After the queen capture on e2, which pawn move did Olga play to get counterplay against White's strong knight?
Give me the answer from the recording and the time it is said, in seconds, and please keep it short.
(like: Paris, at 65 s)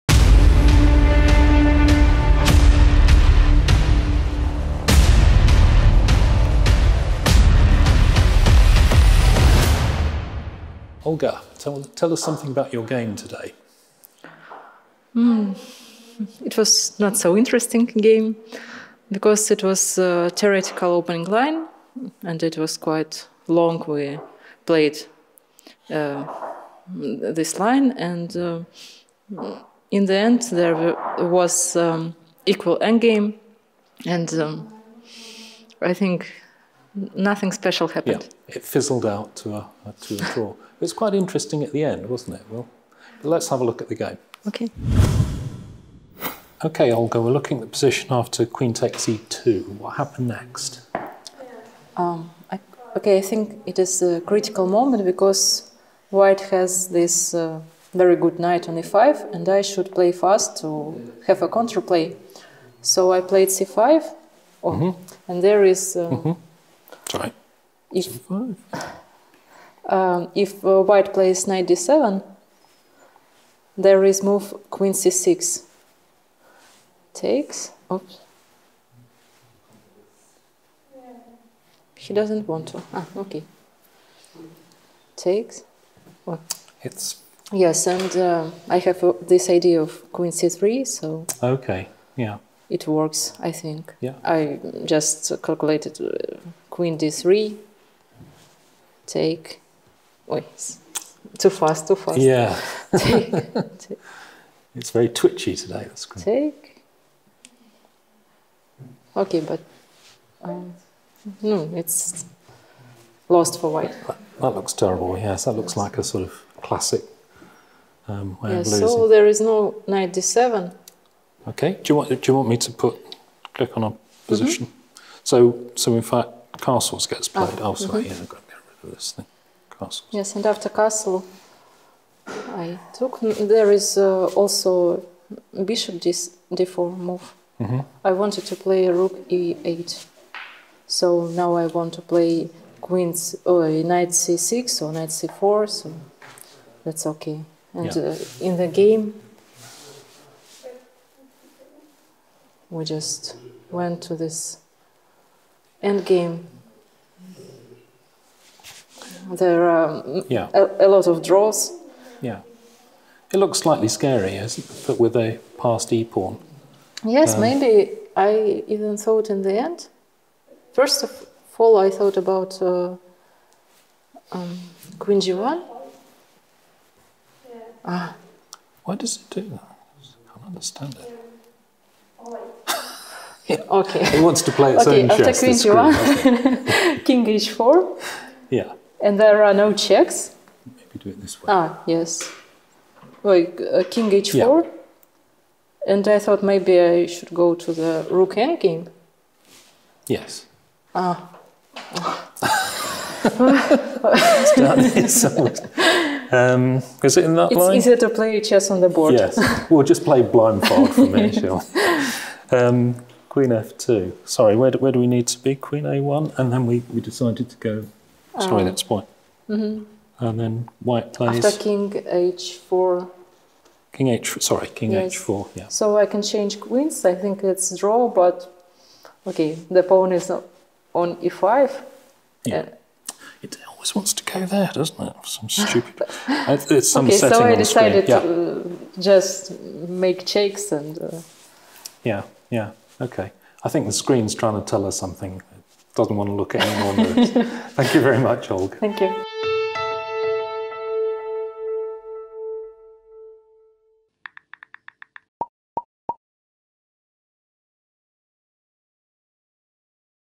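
c5, at 63 s.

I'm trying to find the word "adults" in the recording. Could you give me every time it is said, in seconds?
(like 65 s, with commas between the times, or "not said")
not said.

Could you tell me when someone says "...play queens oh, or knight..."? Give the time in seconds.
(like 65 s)
142 s.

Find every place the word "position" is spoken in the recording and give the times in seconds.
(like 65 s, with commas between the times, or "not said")
47 s, 124 s.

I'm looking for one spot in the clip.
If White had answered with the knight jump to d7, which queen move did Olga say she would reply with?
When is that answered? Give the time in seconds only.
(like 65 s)
74 s.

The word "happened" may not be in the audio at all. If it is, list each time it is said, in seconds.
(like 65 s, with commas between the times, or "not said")
37 s, 49 s.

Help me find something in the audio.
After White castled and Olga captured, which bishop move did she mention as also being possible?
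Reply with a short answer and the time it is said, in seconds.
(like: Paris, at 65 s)
Bishop d4, at 135 s.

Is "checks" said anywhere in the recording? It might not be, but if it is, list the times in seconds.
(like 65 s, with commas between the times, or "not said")
189 s, 240 s.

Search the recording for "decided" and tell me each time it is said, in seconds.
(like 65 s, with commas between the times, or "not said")
216 s, 237 s.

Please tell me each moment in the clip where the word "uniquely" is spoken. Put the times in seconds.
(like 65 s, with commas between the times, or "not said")
not said.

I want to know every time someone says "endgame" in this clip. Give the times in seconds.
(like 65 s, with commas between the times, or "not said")
32 s, 198 s.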